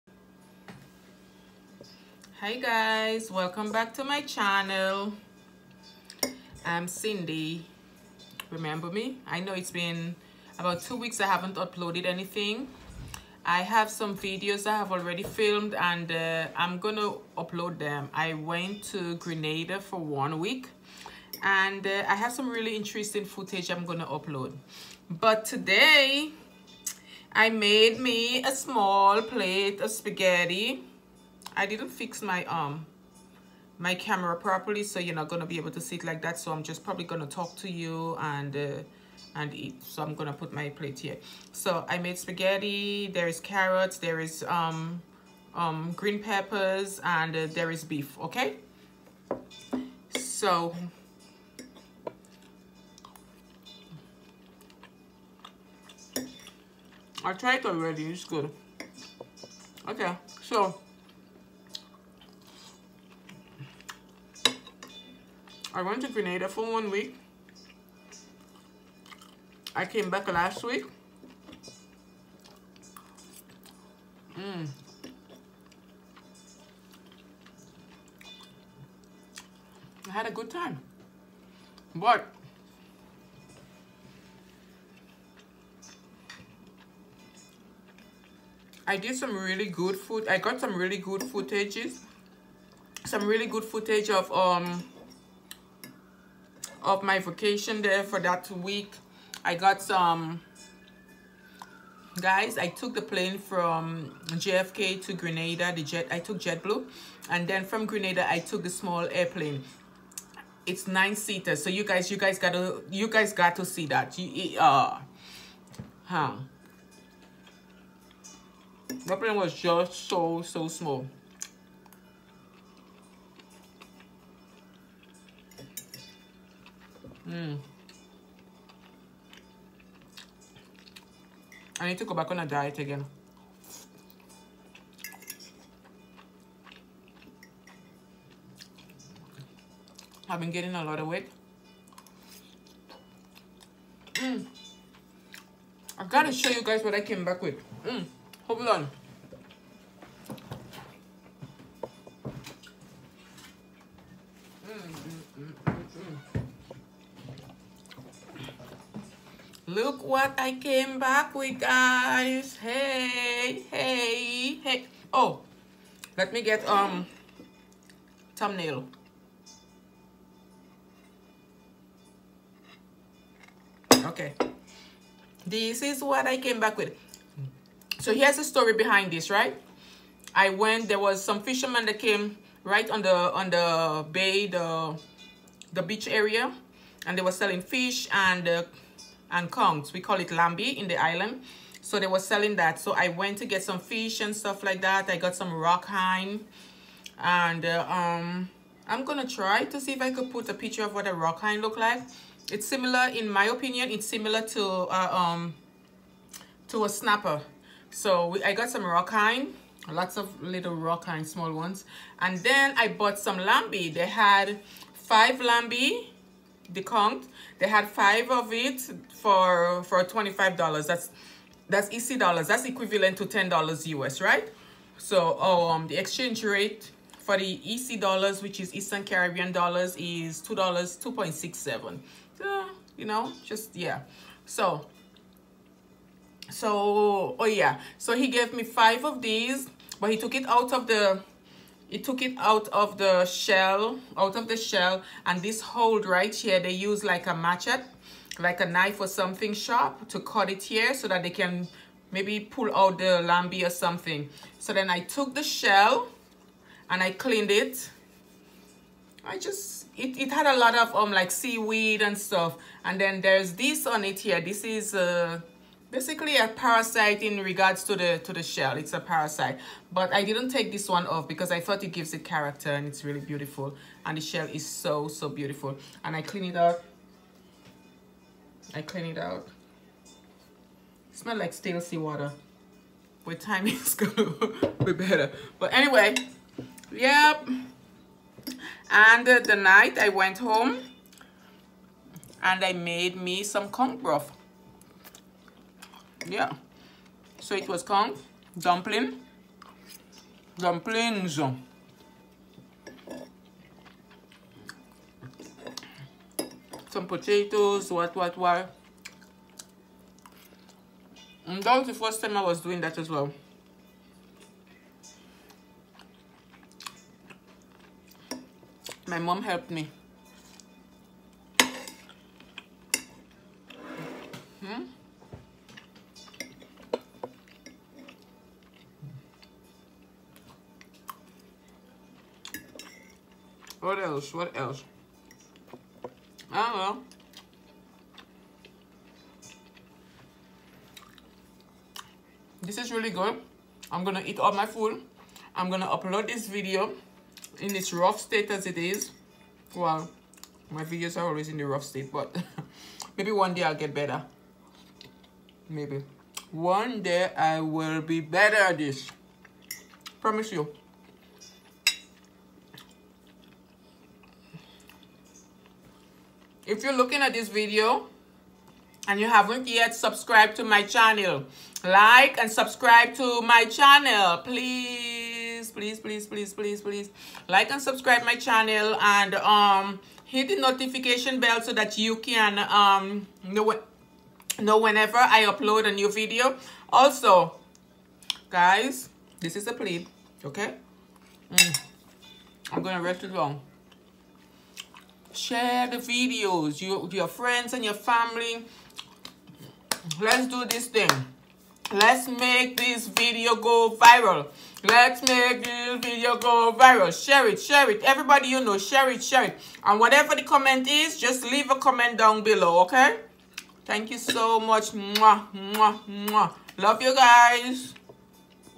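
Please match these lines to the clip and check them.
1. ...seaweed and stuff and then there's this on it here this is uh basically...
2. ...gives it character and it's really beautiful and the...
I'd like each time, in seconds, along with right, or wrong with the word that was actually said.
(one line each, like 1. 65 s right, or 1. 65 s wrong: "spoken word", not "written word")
1. 261 s right
2. 271 s right.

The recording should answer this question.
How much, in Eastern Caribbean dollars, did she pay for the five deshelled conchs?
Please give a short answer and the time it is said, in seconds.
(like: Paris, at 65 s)
$25, at 220 s.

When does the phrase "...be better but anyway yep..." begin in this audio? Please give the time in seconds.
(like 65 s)
284 s.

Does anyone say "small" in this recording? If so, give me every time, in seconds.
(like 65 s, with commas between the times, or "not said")
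28 s, 108 s, 120 s, 211 s.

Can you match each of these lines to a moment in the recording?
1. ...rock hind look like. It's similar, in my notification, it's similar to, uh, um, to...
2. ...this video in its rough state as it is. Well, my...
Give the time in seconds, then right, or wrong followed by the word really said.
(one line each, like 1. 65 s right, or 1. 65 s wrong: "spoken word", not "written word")
1. 201 s wrong: "opinion", not "notification"
2. 346 s right.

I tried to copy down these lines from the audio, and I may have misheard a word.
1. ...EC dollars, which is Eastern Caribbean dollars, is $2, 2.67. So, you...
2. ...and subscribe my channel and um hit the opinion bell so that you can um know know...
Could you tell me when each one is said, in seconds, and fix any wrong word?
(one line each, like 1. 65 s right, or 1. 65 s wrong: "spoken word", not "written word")
1. 227 s right
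2. 377 s wrong: "notification", not "opinion".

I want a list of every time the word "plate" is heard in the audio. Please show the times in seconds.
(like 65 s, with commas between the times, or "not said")
29 s, 40 s.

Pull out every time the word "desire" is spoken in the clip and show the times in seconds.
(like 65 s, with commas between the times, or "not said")
not said.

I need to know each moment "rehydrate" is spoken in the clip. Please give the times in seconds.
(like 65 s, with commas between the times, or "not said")
not said.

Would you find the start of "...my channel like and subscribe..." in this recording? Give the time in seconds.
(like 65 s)
370 s.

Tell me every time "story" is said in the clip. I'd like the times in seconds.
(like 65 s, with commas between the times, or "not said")
178 s.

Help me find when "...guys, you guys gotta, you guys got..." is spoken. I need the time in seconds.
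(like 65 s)
111 s.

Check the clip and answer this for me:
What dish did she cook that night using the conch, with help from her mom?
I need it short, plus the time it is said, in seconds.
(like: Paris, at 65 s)
Conch broth, at 293 s.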